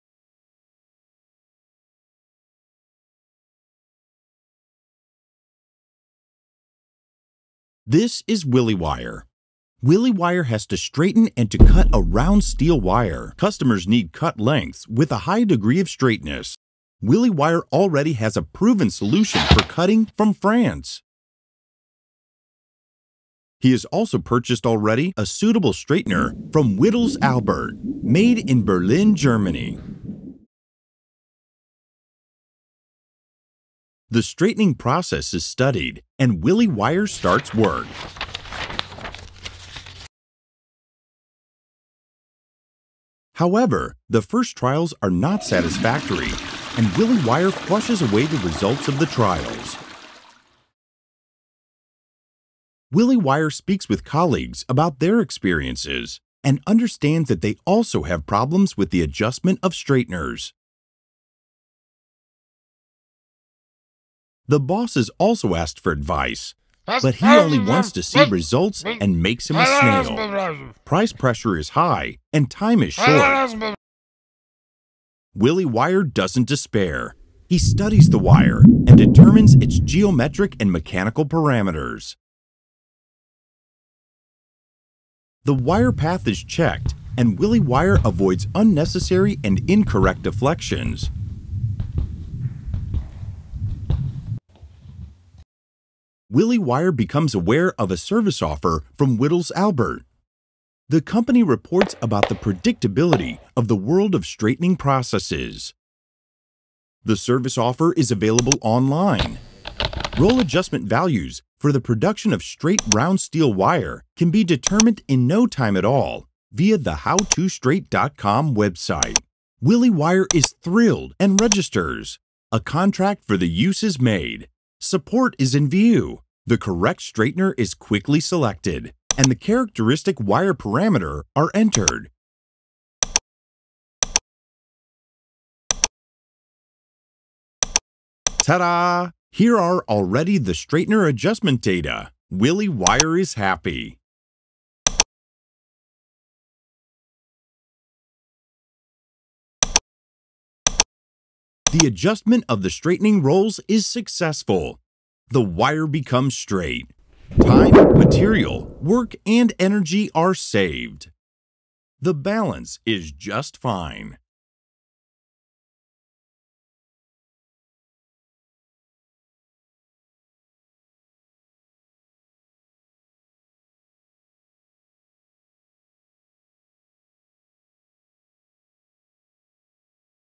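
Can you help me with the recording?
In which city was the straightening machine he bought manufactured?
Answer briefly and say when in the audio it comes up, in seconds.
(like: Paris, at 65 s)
Berlin, at 28 s.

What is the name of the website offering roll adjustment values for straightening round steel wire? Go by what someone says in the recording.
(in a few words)
How2Straight.com.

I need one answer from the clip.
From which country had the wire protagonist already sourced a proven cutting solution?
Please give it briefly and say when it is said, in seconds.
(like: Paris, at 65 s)
France, at 20 s.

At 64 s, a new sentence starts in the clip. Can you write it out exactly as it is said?
The boss is also asked for advice, but he only wants to see results and makes him a snail.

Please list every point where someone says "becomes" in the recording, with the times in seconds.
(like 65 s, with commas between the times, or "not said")
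96 s, 155 s.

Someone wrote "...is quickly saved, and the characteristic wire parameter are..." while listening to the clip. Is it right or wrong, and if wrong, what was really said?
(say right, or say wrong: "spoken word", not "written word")
wrong: "selected", not "saved".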